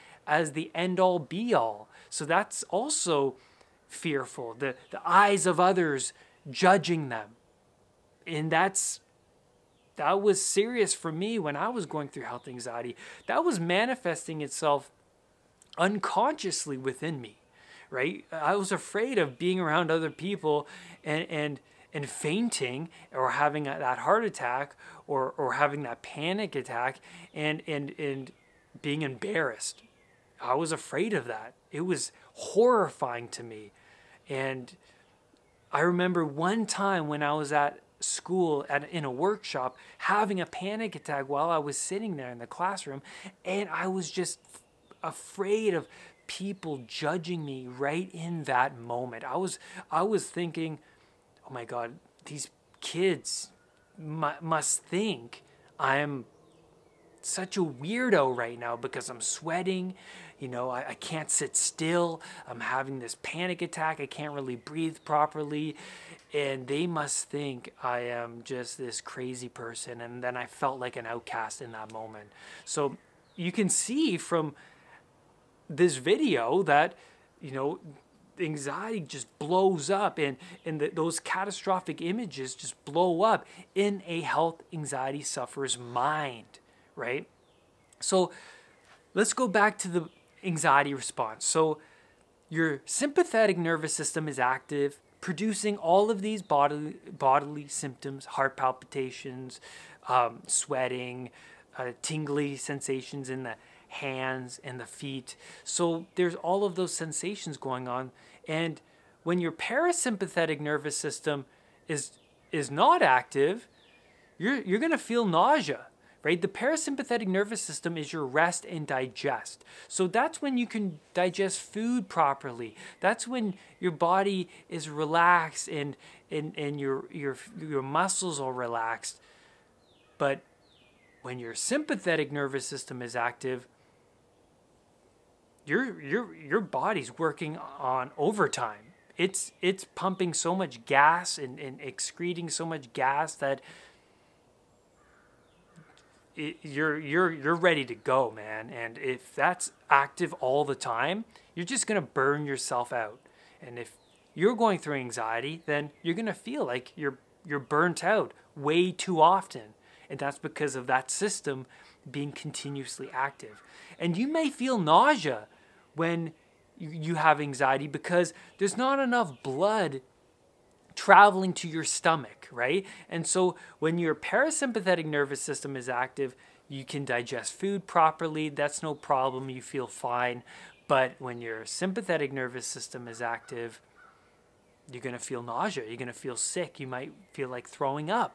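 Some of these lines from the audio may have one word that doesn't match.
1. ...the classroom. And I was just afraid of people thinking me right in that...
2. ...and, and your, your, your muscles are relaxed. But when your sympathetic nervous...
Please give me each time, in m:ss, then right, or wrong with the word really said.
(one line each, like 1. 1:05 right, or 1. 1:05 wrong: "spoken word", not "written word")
1. 0:42 wrong: "judging", not "thinking"
2. 2:06 right.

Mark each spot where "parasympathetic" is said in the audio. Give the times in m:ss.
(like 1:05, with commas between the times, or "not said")
1:49, 1:56, 2:54.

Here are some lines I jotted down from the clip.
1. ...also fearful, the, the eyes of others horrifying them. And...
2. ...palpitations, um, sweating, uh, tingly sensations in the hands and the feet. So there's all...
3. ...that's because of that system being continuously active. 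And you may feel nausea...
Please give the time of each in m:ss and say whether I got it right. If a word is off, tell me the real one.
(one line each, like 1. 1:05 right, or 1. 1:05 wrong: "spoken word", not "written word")
1. 0:02 wrong: "judging", not "horrifying"
2. 1:38 right
3. 2:40 right.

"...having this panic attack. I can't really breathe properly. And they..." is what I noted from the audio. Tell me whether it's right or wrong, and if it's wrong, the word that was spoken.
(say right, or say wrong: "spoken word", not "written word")
right.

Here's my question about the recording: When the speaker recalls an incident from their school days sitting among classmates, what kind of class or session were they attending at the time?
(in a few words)
a workshop.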